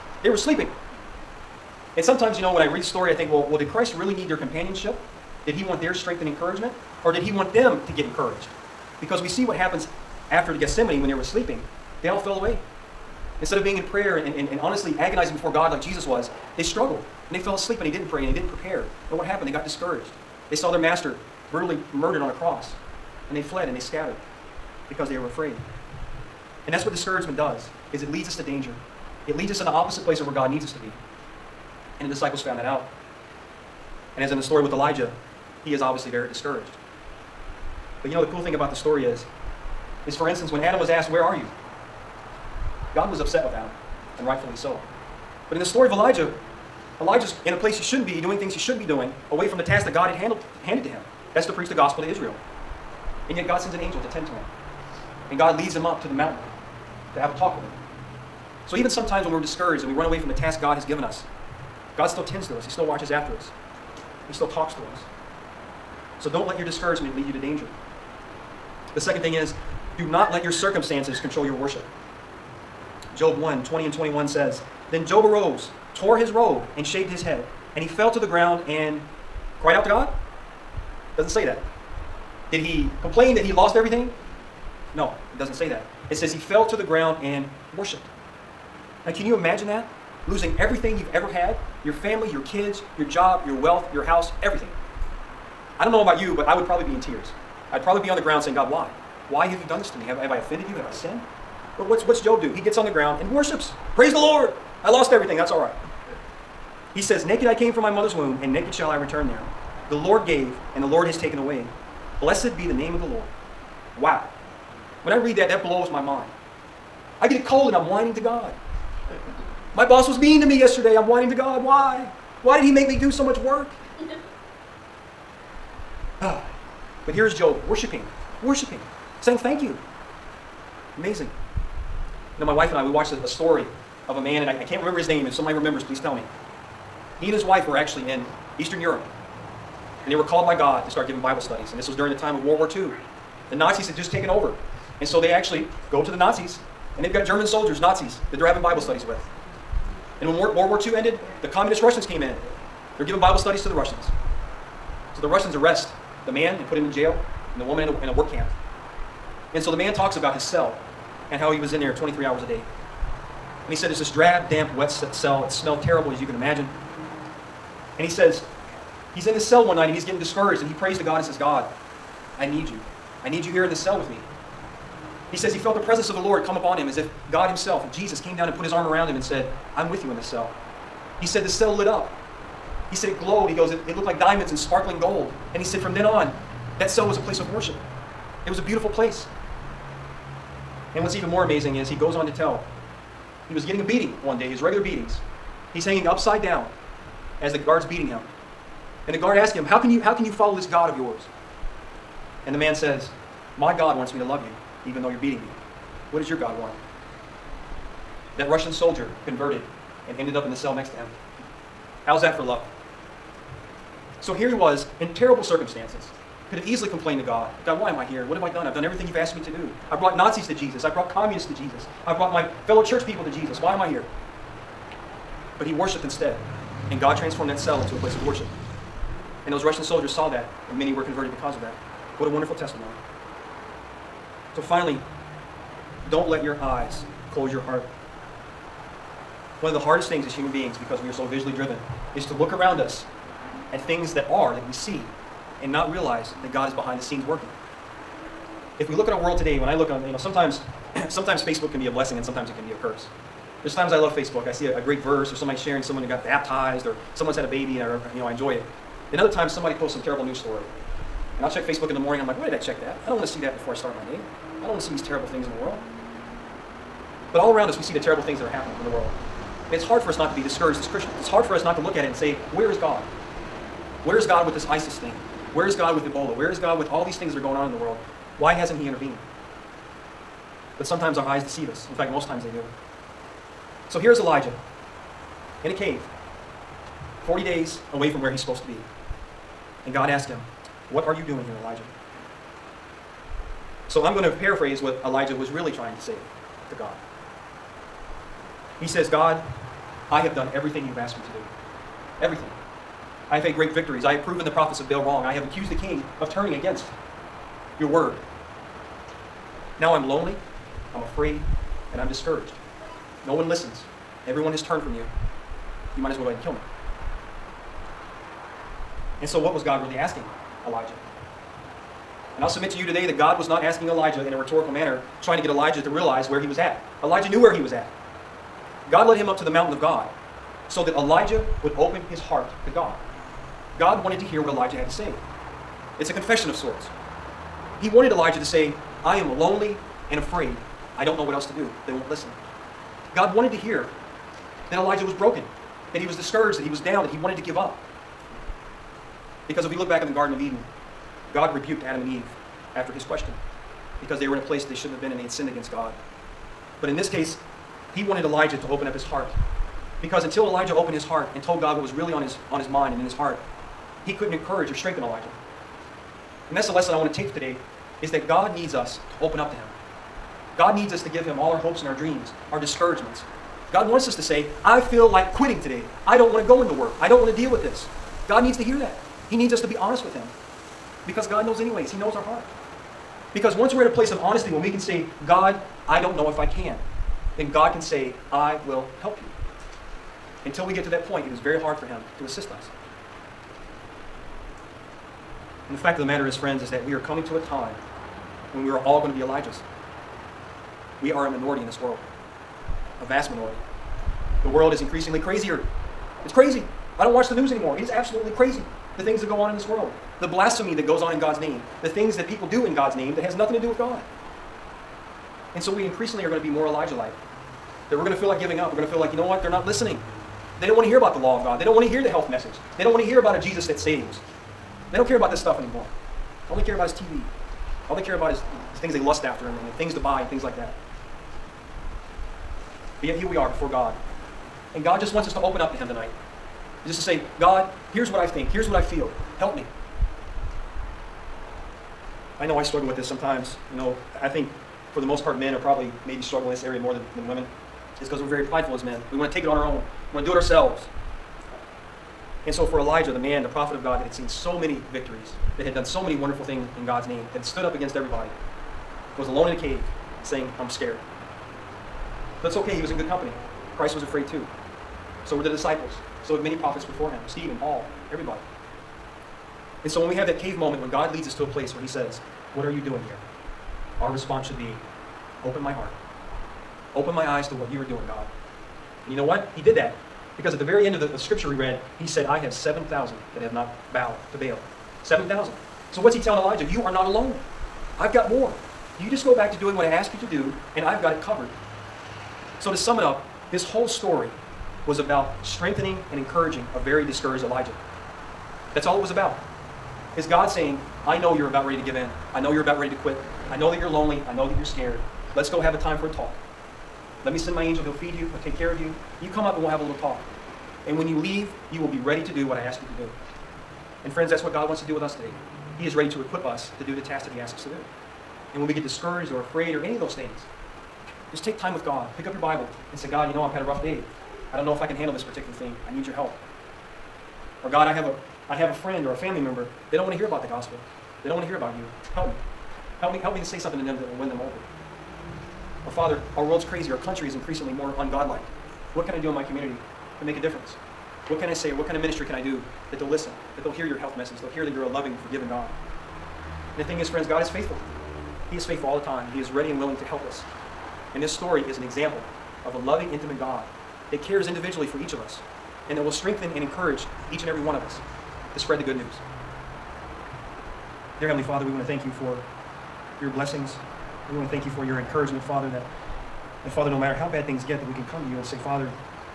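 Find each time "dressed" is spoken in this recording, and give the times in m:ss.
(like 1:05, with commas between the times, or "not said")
not said.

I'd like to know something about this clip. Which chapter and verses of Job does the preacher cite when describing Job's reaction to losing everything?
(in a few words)
Job 1:20-21.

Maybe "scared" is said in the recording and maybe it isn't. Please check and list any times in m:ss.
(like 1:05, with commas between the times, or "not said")
7:40, 8:24.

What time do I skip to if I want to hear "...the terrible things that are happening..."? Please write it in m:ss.
4:27.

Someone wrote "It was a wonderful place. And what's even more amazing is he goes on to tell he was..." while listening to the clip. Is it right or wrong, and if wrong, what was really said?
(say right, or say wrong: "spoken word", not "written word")
wrong: "beautiful", not "wonderful".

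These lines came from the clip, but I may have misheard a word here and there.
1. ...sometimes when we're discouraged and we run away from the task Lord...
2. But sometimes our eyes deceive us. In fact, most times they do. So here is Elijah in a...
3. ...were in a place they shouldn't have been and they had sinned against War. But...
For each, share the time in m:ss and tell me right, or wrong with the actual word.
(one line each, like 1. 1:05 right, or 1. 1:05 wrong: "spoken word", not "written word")
1. 0:58 wrong: "God", not "Lord"
2. 4:40 right
3. 5:54 wrong: "God", not "War".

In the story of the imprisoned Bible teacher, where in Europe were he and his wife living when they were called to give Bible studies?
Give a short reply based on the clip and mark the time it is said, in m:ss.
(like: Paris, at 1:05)
Eastern Europe, at 2:18.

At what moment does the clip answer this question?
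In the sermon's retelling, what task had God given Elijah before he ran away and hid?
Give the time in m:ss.
0:51.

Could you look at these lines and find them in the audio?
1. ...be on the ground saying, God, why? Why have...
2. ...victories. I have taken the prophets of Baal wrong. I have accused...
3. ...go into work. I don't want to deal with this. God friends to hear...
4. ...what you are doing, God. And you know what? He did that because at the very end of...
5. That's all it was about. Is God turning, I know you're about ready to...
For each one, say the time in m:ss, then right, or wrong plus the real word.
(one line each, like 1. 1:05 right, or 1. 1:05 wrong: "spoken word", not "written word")
1. 1:38 right
2. 5:03 wrong: "proven", not "taken"
3. 6:16 wrong: "needs", not "friends"
4. 7:57 right
5. 8:18 wrong: "saying", not "turning".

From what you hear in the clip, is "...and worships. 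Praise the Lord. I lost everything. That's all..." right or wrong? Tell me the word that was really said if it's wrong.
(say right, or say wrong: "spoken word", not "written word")
right.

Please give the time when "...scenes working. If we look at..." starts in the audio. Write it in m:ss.
4:07.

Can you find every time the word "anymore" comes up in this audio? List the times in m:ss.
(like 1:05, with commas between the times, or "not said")
6:47, 7:05.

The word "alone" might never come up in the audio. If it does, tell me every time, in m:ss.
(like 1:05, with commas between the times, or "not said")
7:39, 8:07.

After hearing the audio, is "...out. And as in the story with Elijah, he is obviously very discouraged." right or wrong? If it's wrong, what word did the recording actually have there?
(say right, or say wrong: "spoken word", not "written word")
right.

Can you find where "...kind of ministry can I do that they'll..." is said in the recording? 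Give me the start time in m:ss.
9:01.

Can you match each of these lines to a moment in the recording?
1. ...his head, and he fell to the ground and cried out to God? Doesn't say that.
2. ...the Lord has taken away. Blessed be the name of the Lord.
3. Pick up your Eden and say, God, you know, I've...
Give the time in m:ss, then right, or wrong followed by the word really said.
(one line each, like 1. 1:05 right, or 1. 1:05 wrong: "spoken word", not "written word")
1. 1:17 right
2. 1:50 right
3. 8:42 wrong: "Bible", not "Eden".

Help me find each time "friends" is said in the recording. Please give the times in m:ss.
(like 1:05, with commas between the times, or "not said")
6:36, 8:34, 8:48, 9:07.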